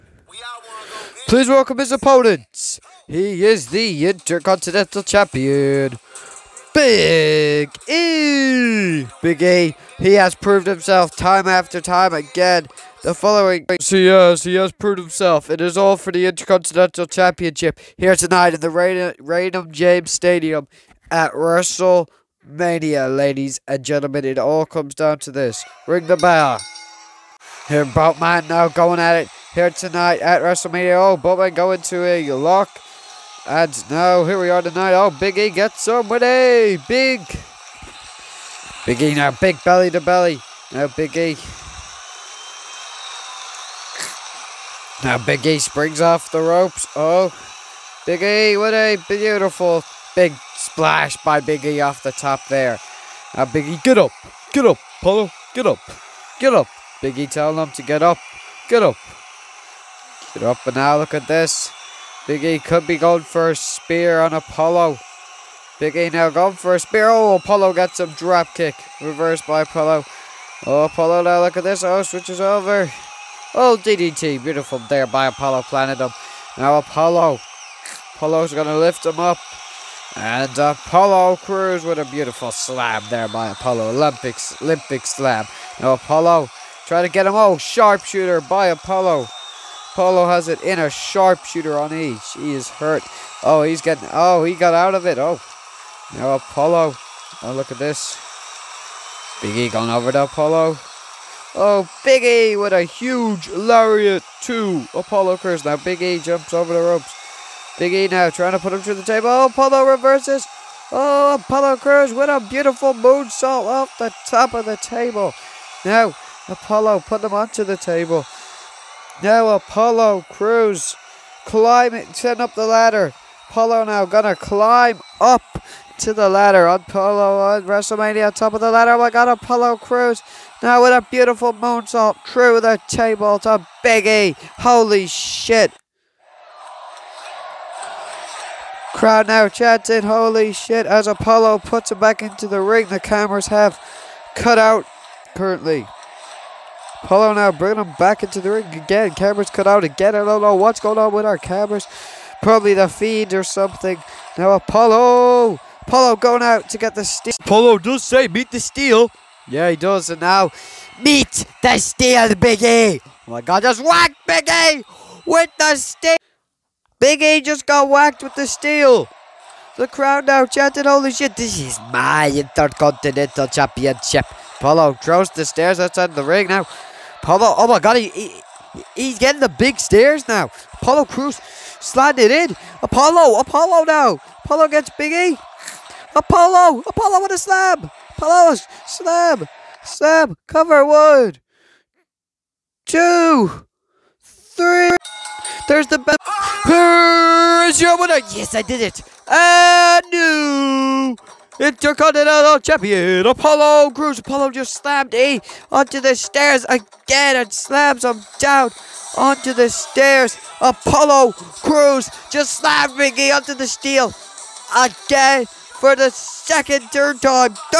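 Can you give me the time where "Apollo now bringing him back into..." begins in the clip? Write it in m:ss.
2:27.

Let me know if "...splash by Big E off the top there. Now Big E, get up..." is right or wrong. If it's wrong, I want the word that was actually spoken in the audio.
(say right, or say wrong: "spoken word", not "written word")
right.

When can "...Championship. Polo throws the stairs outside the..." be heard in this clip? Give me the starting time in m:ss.
2:53.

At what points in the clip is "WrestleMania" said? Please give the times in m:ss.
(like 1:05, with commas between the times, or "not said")
0:21, 0:30, 2:07.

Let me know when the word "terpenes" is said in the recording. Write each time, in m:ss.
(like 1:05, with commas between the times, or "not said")
not said.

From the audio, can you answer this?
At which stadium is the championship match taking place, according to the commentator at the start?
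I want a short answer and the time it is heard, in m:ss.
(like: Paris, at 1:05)
Raymond James Stadium, at 0:18.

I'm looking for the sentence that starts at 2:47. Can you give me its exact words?
Biggie just got whacked with the steal.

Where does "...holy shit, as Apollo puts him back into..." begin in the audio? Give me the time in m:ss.
2:20.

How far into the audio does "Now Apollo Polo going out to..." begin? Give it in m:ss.
2:34.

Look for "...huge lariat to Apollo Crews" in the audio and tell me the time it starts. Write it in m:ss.
1:42.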